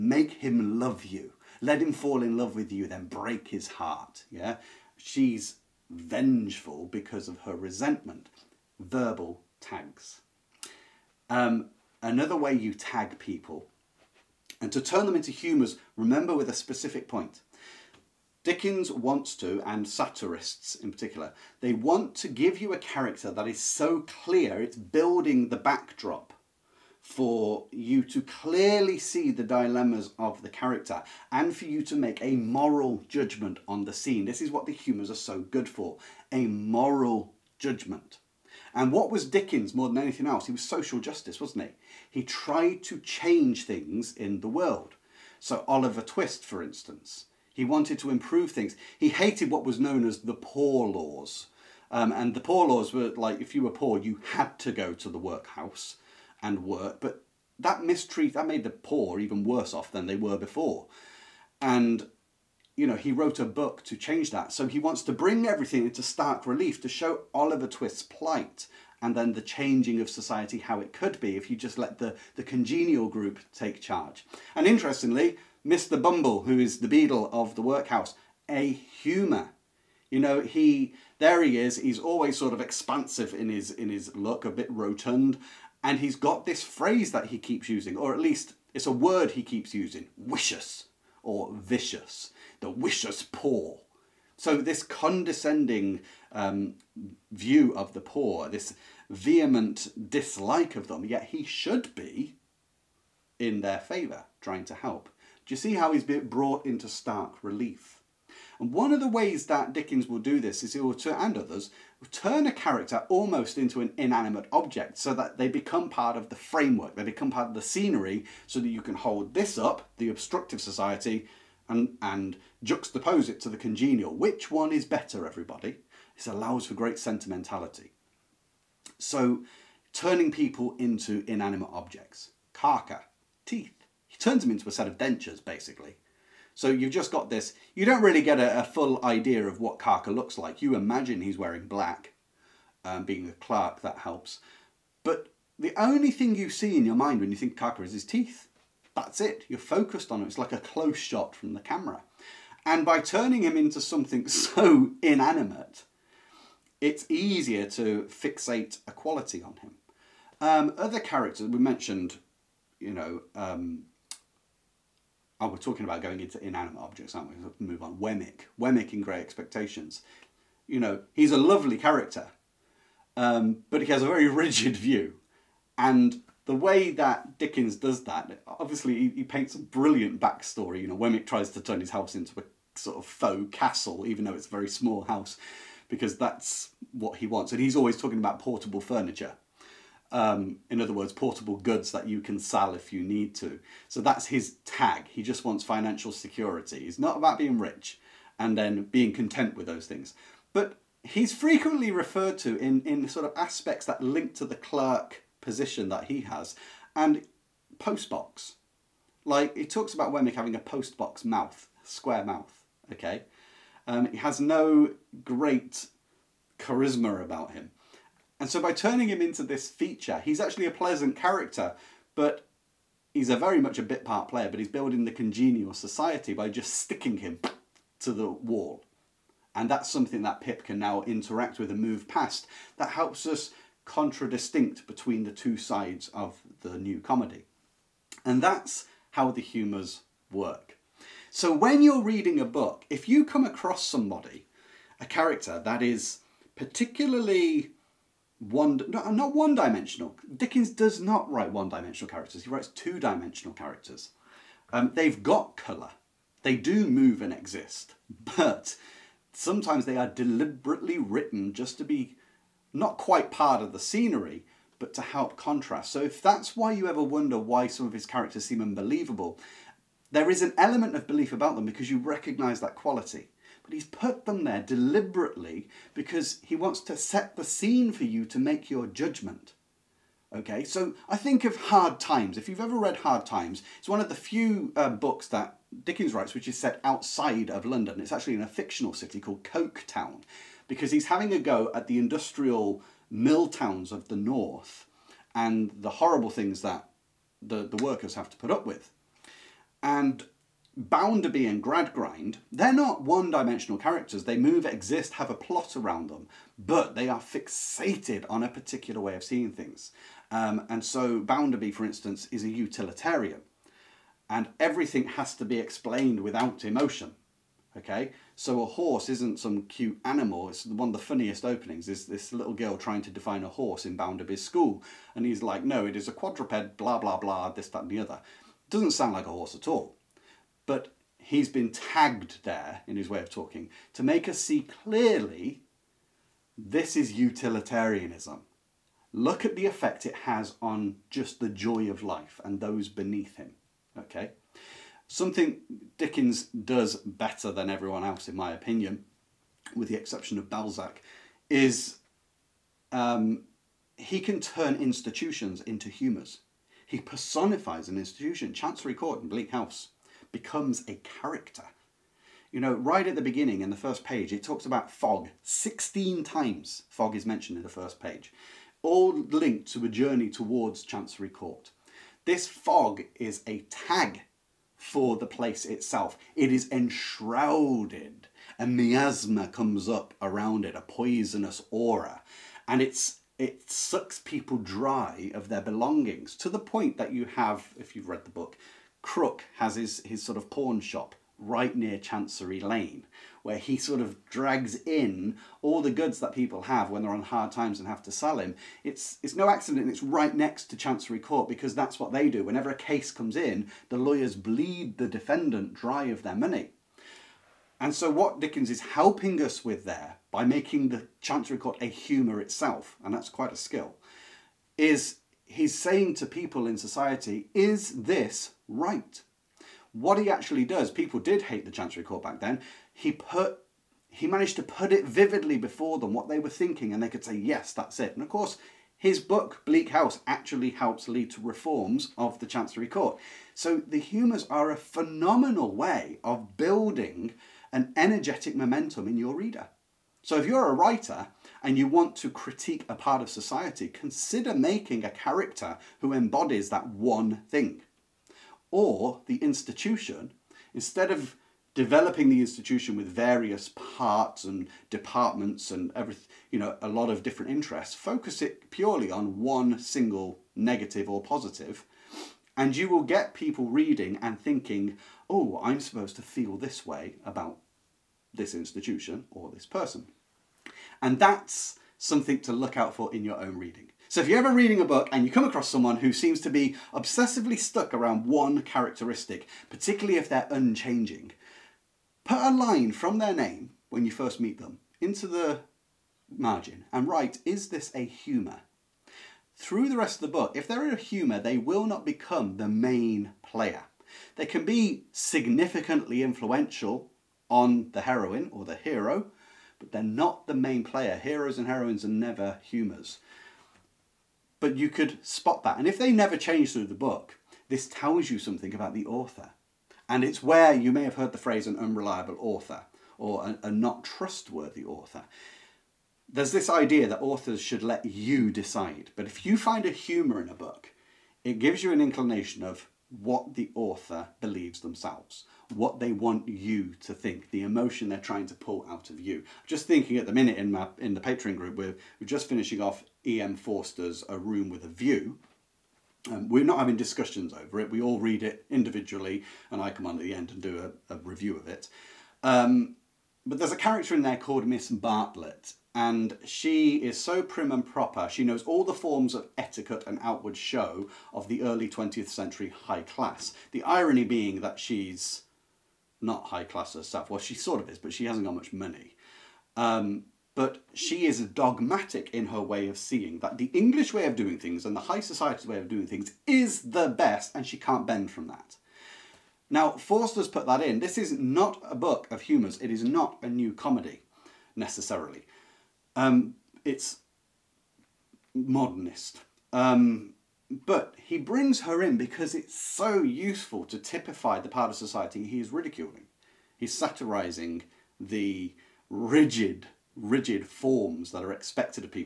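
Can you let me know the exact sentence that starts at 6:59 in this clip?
what he actually does, people did hate the Chancery Court back then.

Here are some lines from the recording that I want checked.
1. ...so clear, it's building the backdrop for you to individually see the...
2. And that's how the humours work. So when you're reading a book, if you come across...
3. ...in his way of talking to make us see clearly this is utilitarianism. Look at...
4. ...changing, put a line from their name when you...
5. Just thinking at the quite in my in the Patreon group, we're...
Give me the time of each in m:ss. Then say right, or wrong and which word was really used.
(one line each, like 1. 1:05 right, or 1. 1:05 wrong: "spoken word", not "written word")
1. 0:23 wrong: "clearly", not "individually"
2. 3:58 right
3. 5:32 right
4. 8:00 wrong: "unchanging", not "changing"
5. 8:49 wrong: "minute", not "quite".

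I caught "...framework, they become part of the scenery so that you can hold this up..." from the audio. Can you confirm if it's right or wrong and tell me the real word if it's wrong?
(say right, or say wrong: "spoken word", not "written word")
right.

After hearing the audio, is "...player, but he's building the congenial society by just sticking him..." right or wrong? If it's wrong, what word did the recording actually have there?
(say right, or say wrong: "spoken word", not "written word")
right.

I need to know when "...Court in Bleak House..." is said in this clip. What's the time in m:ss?
5:58.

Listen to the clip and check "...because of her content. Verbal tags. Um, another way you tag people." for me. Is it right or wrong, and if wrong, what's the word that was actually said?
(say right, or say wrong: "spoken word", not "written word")
wrong: "resentment", not "content".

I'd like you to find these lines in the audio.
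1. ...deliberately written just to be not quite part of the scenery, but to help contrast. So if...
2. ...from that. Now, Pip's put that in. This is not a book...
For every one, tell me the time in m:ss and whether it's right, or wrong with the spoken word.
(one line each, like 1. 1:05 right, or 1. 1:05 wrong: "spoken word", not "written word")
1. 4:20 right
2. 9:28 wrong: "Forster", not "Pip".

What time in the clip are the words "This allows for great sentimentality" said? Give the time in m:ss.
2:06.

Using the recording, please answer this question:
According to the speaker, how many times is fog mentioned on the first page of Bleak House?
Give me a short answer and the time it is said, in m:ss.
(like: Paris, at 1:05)
16, at 6:05.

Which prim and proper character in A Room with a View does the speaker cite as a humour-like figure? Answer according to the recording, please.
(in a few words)
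Miss Bartlett.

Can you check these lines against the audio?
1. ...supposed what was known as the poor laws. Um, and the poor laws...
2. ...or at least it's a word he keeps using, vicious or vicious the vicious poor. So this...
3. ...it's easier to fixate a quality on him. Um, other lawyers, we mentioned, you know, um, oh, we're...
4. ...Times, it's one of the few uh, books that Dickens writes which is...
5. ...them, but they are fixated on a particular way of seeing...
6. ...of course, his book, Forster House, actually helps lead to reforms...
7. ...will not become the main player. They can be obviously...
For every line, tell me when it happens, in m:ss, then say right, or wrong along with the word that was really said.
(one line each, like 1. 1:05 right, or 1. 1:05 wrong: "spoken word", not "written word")
1. 0:49 wrong: "hated", not "supposed"
2. 1:27 right
3. 2:36 wrong: "characters", not "lawyers"
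4. 4:43 right
5. 5:06 right
6. 7:08 wrong: "Bleak", not "Forster"
7. 8:11 wrong: "significantly", not "obviously".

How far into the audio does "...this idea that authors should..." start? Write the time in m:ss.
8:36.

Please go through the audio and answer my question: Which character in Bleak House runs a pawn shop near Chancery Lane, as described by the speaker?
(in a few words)
Crook.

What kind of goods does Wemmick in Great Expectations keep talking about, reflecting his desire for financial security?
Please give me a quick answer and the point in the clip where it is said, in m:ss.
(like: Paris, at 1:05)
Portable furniture, at 3:08.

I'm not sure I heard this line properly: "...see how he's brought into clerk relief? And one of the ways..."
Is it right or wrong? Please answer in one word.
wrong.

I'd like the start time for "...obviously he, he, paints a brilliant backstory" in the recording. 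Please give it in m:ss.
2:58.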